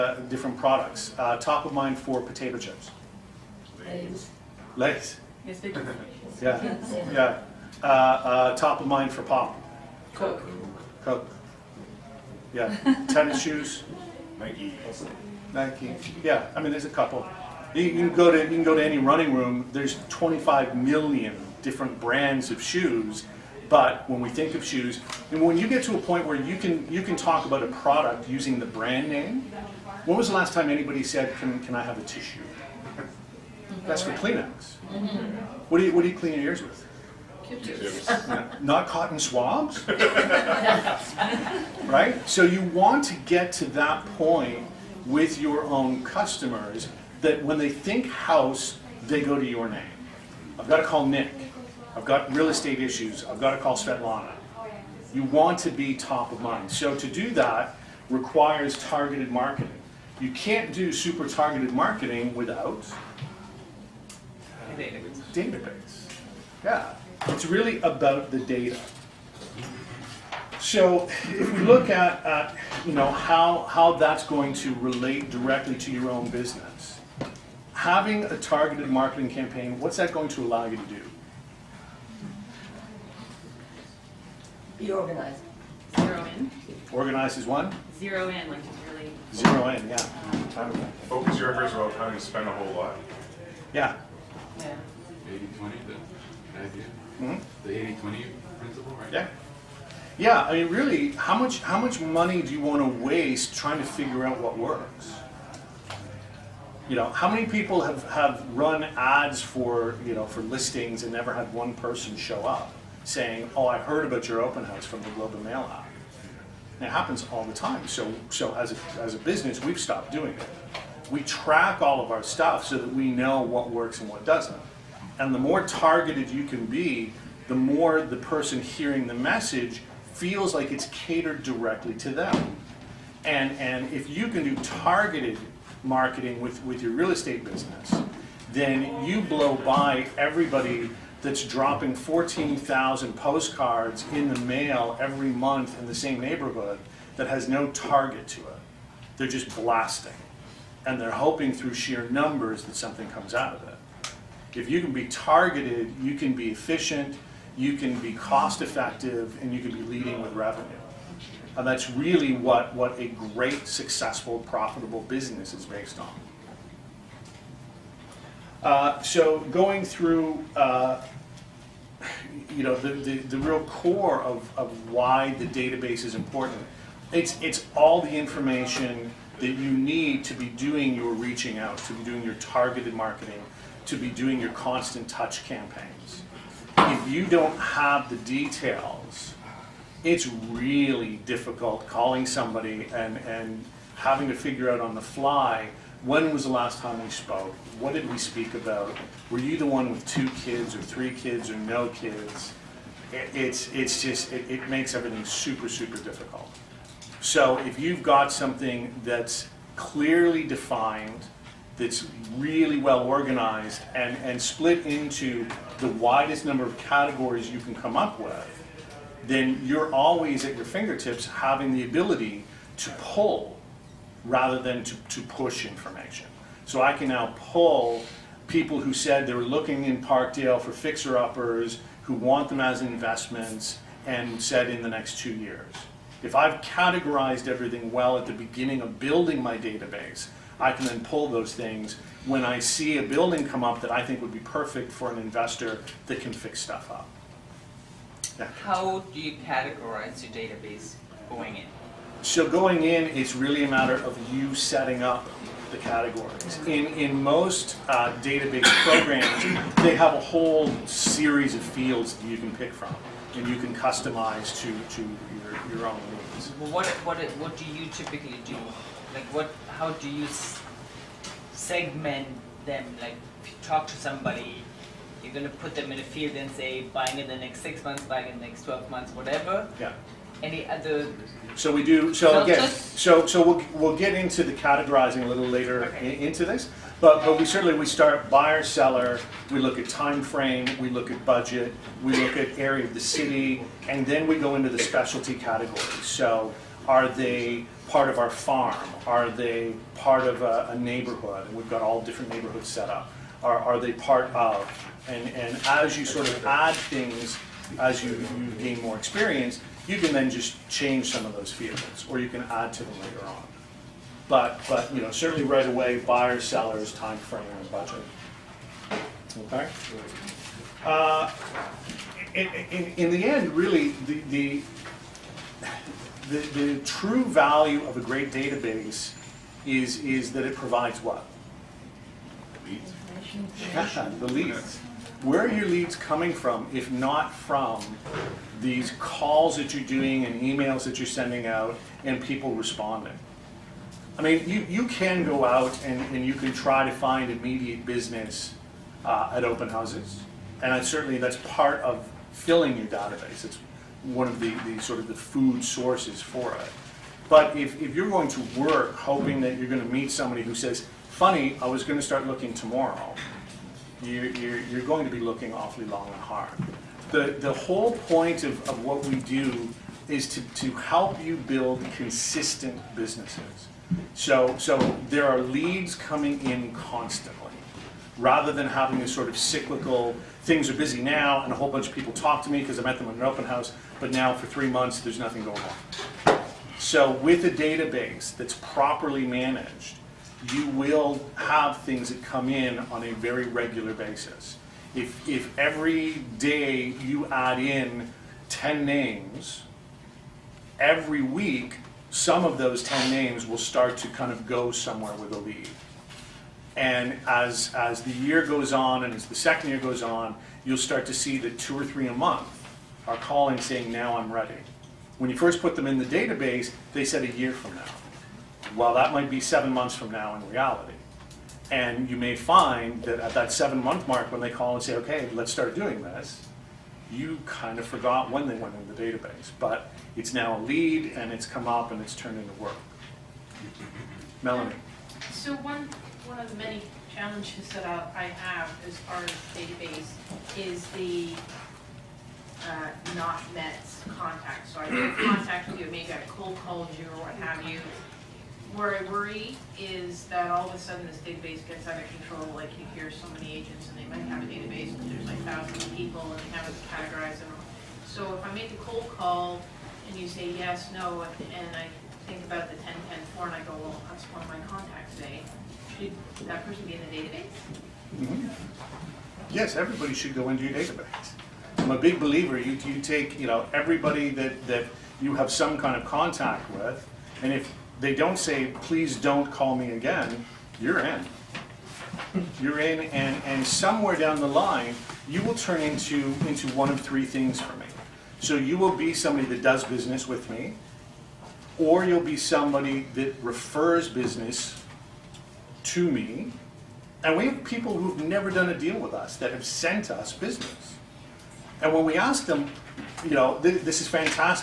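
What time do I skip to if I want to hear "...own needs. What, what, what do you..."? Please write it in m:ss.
4:25.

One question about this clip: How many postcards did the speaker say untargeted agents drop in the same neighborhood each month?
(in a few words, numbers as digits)
14,000.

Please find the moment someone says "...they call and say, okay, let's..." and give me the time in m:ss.
7:04.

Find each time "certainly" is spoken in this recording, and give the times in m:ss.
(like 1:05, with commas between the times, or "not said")
4:47, 5:15, 5:50.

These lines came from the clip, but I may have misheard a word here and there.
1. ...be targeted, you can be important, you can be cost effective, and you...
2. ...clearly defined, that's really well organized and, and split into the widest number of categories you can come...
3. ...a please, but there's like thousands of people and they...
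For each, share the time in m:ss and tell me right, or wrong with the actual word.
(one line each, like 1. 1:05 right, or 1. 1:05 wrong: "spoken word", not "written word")
1. 2:34 wrong: "efficient", not "important"
2. 3:29 right
3. 7:34 wrong: "database", not "please".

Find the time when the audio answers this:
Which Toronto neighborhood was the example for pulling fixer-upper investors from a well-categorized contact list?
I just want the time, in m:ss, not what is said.
3:50.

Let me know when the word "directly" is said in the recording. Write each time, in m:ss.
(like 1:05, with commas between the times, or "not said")
1:15, 2:11.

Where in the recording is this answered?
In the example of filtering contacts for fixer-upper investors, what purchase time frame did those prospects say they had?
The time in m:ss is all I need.
3:54.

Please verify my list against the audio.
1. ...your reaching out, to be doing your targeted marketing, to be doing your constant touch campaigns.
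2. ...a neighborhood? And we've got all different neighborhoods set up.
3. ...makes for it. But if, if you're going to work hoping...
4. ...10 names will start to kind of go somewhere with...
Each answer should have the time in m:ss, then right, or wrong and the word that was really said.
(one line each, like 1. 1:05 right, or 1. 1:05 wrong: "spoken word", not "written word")
1. 3:00 right
2. 5:00 right
3. 5:55 wrong: "sources", not "makes"
4. 6:42 right.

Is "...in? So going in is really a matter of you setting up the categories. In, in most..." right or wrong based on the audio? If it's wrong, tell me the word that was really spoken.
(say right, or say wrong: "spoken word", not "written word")
right.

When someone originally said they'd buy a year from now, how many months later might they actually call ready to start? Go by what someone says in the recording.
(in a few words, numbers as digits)
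7.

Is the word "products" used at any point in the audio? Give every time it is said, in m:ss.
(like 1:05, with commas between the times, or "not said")
0:00, 0:27.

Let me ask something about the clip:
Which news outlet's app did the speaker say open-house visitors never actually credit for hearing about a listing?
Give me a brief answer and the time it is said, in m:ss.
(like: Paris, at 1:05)
Globe and Mail, at 1:55.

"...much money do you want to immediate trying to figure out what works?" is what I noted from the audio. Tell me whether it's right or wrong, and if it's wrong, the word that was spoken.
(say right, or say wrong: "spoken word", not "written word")
wrong: "waste", not "immediate".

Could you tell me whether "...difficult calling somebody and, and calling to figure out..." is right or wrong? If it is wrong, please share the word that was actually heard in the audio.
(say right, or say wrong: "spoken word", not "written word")
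wrong: "having", not "calling".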